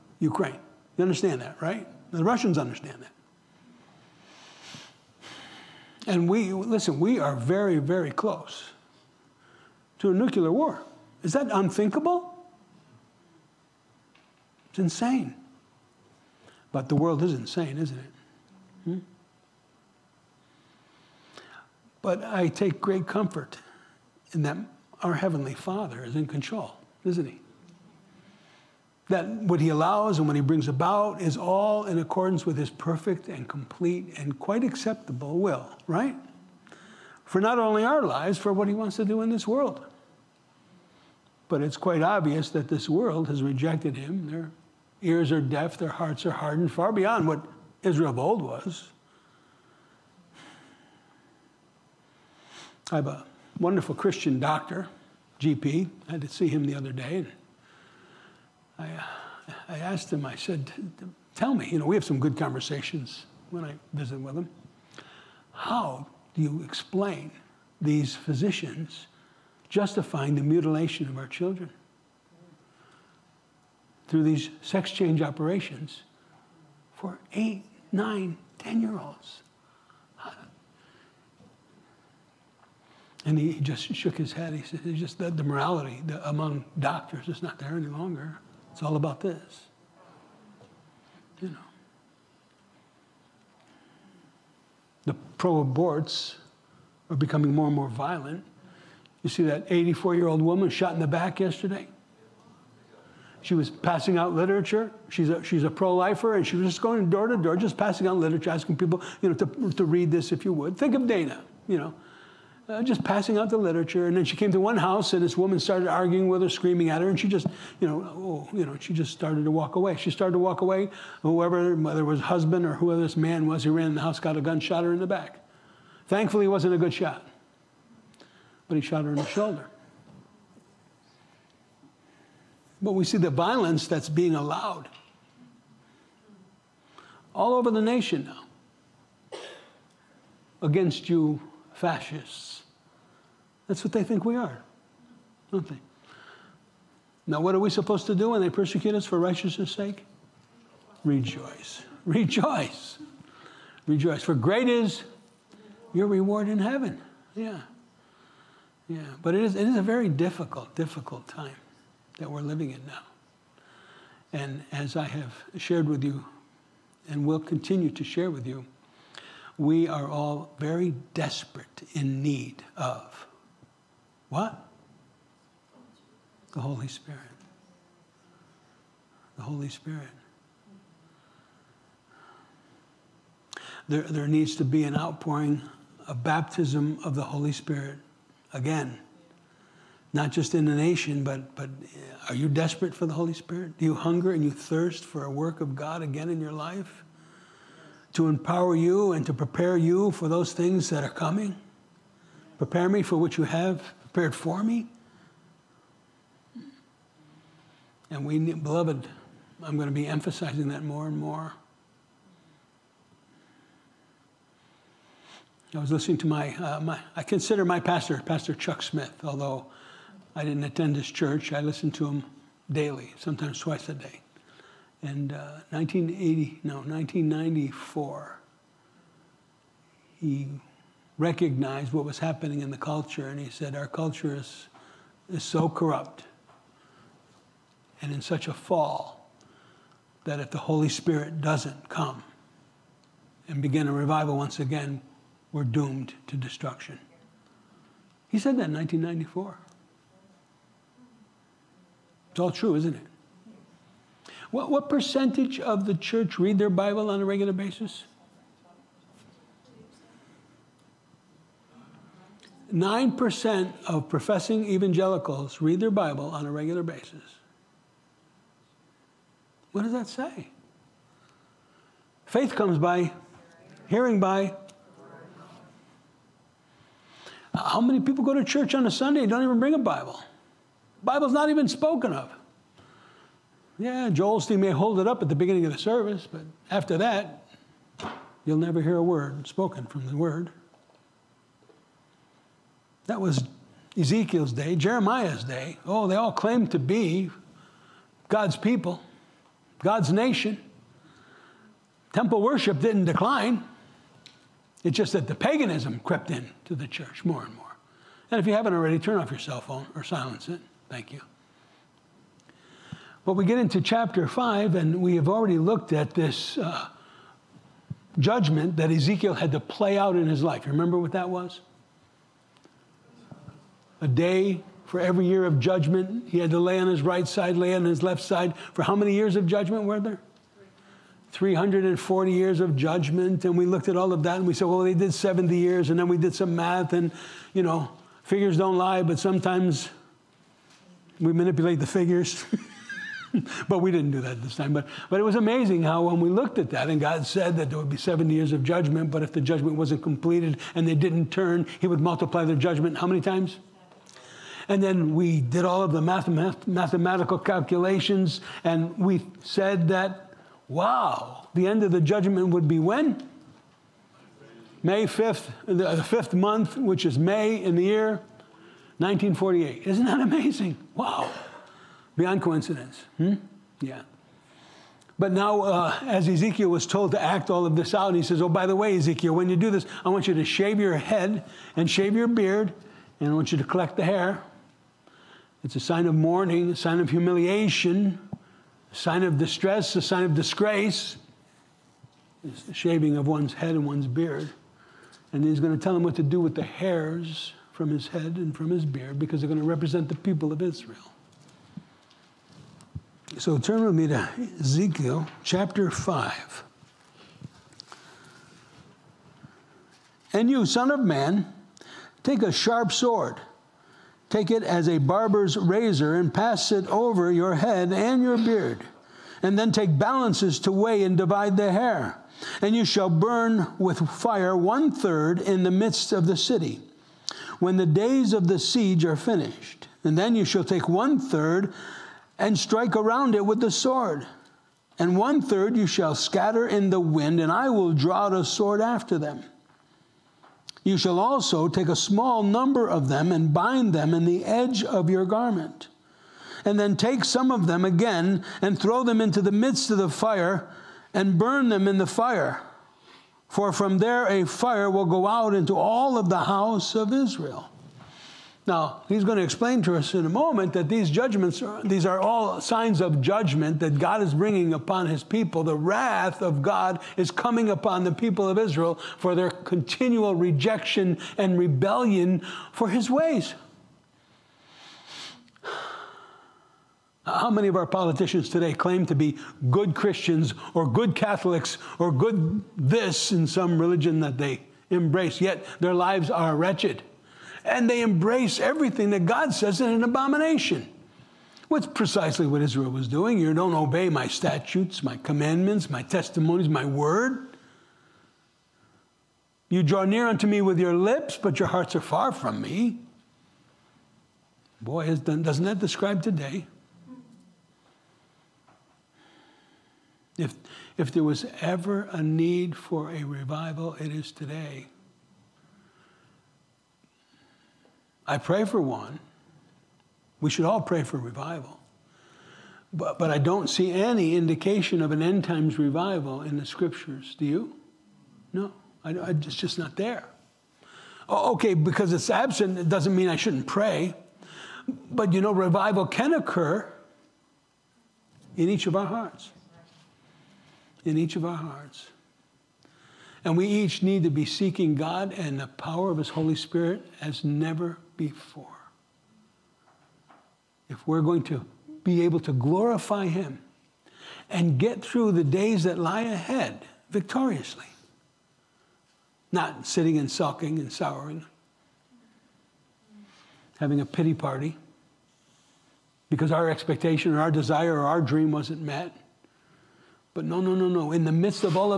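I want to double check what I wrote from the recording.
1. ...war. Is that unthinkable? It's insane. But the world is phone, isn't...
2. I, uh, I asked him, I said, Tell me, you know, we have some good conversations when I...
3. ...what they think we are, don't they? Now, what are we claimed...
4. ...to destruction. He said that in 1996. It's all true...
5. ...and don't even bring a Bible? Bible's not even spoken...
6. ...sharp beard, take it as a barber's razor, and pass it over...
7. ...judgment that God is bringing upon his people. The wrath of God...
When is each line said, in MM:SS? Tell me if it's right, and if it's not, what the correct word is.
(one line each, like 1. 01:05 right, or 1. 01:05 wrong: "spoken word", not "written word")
1. 00:10 wrong: "insane", not "phone"
2. 00:58 right
3. 02:23 wrong: "supposed", not "claimed"
4. 04:06 wrong: "1994", not "1996"
5. 04:39 right
6. 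06:52 wrong: "sword", not "beard"
7. 07:43 right.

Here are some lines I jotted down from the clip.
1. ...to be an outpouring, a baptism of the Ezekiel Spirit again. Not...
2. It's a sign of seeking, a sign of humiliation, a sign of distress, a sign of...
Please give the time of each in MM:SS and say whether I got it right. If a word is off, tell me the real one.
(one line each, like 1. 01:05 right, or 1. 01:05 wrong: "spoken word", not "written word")
1. 03:04 wrong: "Holy", not "Ezekiel"
2. 06:25 wrong: "mourning", not "seeking".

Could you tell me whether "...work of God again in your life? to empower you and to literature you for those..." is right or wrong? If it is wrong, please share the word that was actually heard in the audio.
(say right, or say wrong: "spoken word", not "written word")
wrong: "prepare", not "literature".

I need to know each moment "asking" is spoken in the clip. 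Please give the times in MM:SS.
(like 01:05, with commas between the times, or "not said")
01:48.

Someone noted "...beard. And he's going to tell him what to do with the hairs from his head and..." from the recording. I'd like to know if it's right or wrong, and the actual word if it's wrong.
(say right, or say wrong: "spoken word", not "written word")
right.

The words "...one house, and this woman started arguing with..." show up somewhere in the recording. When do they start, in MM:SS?
01:54.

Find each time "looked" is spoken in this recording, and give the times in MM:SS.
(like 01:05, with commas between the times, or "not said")
05:15, 05:33, 05:46.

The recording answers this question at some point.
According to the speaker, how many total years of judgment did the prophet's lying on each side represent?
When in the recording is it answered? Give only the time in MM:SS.
05:31.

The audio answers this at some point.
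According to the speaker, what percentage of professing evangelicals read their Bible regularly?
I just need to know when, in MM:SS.
04:22.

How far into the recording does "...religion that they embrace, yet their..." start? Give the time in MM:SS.
08:03.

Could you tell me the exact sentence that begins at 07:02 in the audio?
And you shall burn with fire one third in the midst of the city, when the days of the siege are finished.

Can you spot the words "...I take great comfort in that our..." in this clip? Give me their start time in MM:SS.
00:22.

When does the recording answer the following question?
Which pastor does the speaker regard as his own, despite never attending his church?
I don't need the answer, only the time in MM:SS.
03:38.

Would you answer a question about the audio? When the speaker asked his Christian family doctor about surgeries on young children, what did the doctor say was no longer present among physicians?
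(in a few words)
morality.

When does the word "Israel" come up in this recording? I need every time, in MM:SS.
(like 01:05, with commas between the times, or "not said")
00:47, 06:40, 07:37, 07:48, 08:12.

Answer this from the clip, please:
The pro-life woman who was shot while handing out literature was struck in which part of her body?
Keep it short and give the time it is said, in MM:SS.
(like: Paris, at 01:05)
shoulder, at 02:09.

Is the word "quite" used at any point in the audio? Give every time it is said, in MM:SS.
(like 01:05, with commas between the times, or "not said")
00:34, 00:41.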